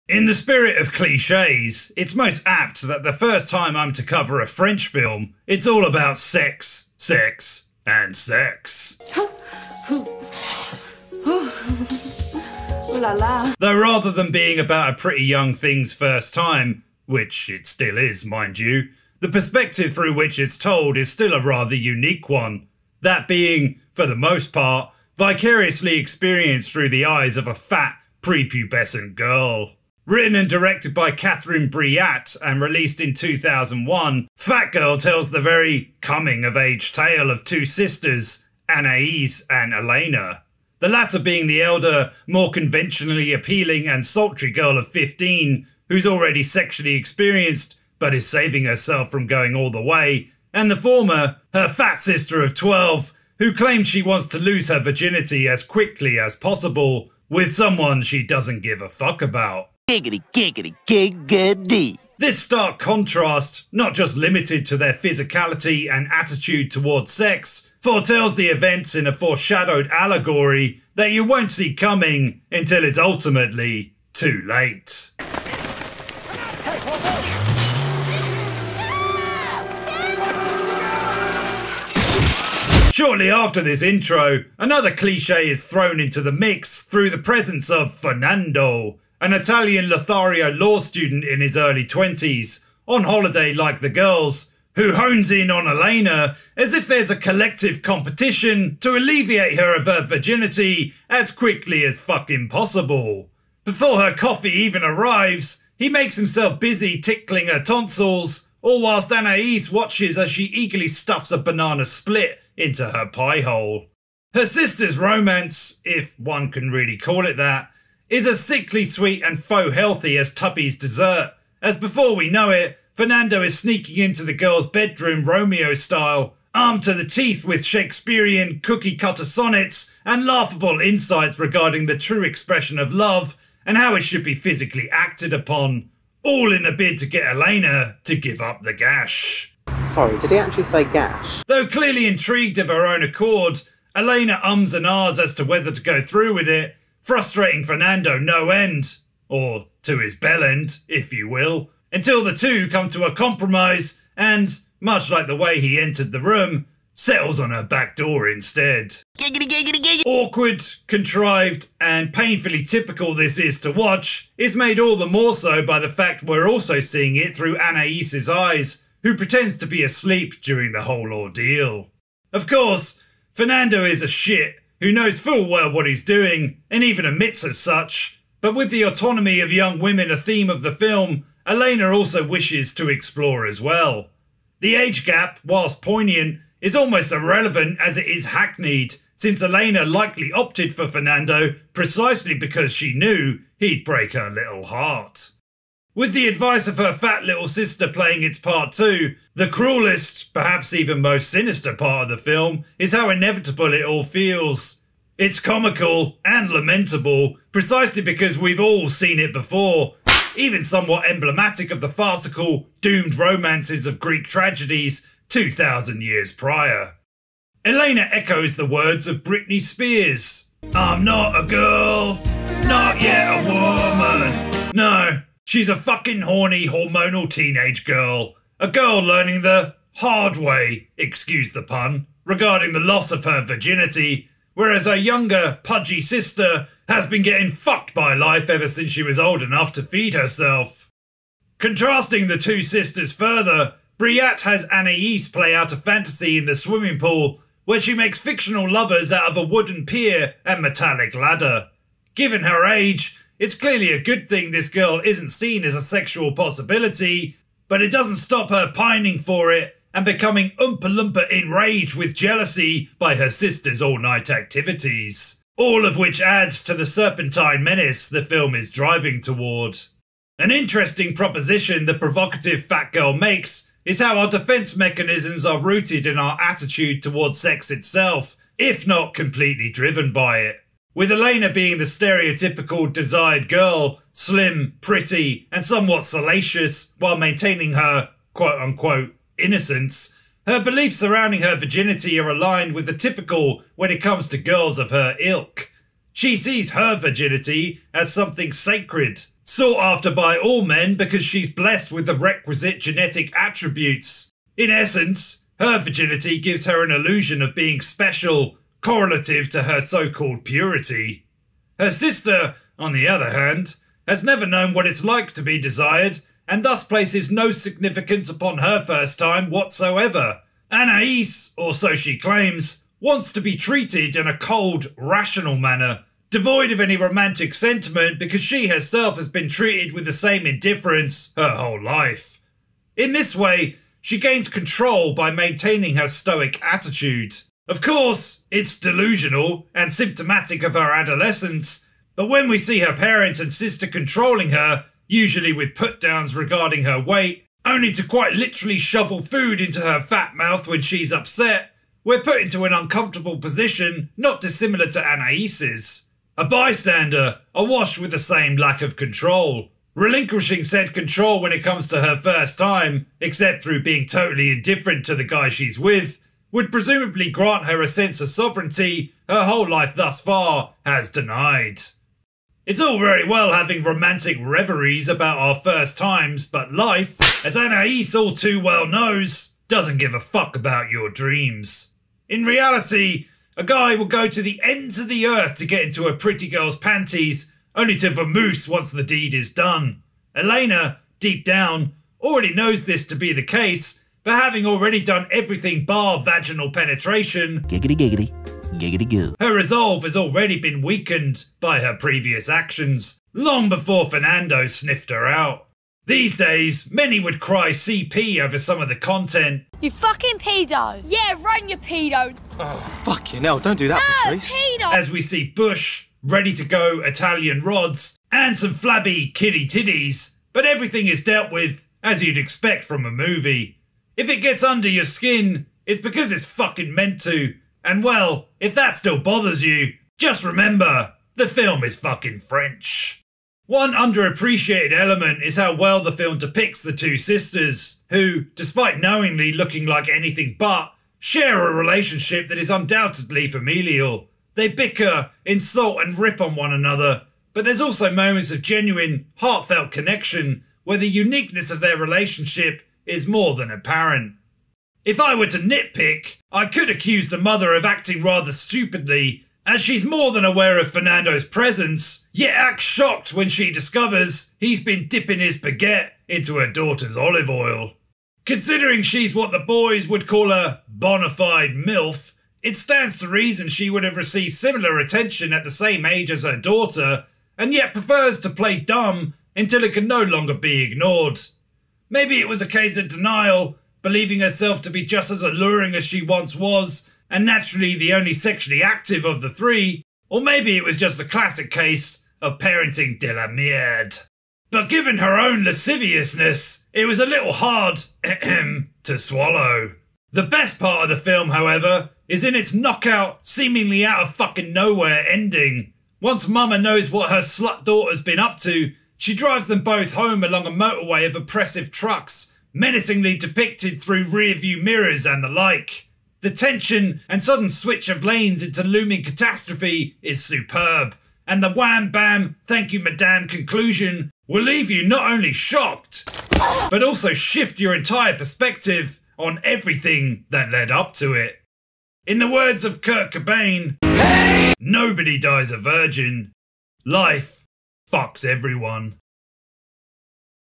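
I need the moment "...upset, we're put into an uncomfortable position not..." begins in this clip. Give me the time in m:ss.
5:51.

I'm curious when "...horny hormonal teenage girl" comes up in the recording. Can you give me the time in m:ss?
3:46.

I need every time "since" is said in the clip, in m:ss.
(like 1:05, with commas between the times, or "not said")
3:09, 3:58.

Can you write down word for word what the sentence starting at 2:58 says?
But with the autonomy of young women a theme of the film, Elena also wishes to explore as well.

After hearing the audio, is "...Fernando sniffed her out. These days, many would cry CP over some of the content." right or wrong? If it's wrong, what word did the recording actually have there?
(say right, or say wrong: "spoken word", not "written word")
right.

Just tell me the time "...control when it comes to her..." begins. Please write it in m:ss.
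6:00.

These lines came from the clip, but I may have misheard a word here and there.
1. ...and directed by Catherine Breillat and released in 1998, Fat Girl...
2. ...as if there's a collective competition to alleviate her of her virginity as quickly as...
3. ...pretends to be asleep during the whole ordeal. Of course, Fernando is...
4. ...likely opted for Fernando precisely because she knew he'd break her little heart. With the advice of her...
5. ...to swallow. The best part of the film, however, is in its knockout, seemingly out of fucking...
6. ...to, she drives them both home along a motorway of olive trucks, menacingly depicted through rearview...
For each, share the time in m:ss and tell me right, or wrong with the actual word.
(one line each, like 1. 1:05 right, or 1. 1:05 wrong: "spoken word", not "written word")
1. 0:30 wrong: "2001", not "1998"
2. 1:36 right
3. 2:49 right
4. 3:09 right
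5. 8:19 right
6. 8:28 wrong: "oppressive", not "olive".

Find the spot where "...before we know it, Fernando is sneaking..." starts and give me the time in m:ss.
2:01.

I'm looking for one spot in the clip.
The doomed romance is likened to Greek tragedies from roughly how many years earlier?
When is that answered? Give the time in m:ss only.
3:35.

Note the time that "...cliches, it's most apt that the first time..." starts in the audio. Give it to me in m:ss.
0:00.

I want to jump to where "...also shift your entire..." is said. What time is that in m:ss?
8:47.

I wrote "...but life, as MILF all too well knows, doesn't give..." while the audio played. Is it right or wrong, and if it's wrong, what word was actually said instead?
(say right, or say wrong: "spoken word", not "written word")
wrong: "Anaïs", not "MILF".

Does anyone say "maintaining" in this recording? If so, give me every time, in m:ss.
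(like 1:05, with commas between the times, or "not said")
4:47, 5:35.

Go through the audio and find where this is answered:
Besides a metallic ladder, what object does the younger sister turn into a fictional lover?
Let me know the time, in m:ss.
4:09.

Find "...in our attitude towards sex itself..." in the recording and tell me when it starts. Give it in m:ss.
4:36.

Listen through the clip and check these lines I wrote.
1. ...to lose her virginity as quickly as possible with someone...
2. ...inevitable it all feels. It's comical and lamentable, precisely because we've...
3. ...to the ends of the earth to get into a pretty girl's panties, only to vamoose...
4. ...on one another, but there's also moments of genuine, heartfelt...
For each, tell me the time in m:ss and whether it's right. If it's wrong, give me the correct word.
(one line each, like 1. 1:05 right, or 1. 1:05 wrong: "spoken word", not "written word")
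1. 0:54 right
2. 3:23 right
3. 6:24 right
4. 7:26 right.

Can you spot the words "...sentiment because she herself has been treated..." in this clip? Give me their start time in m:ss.
5:27.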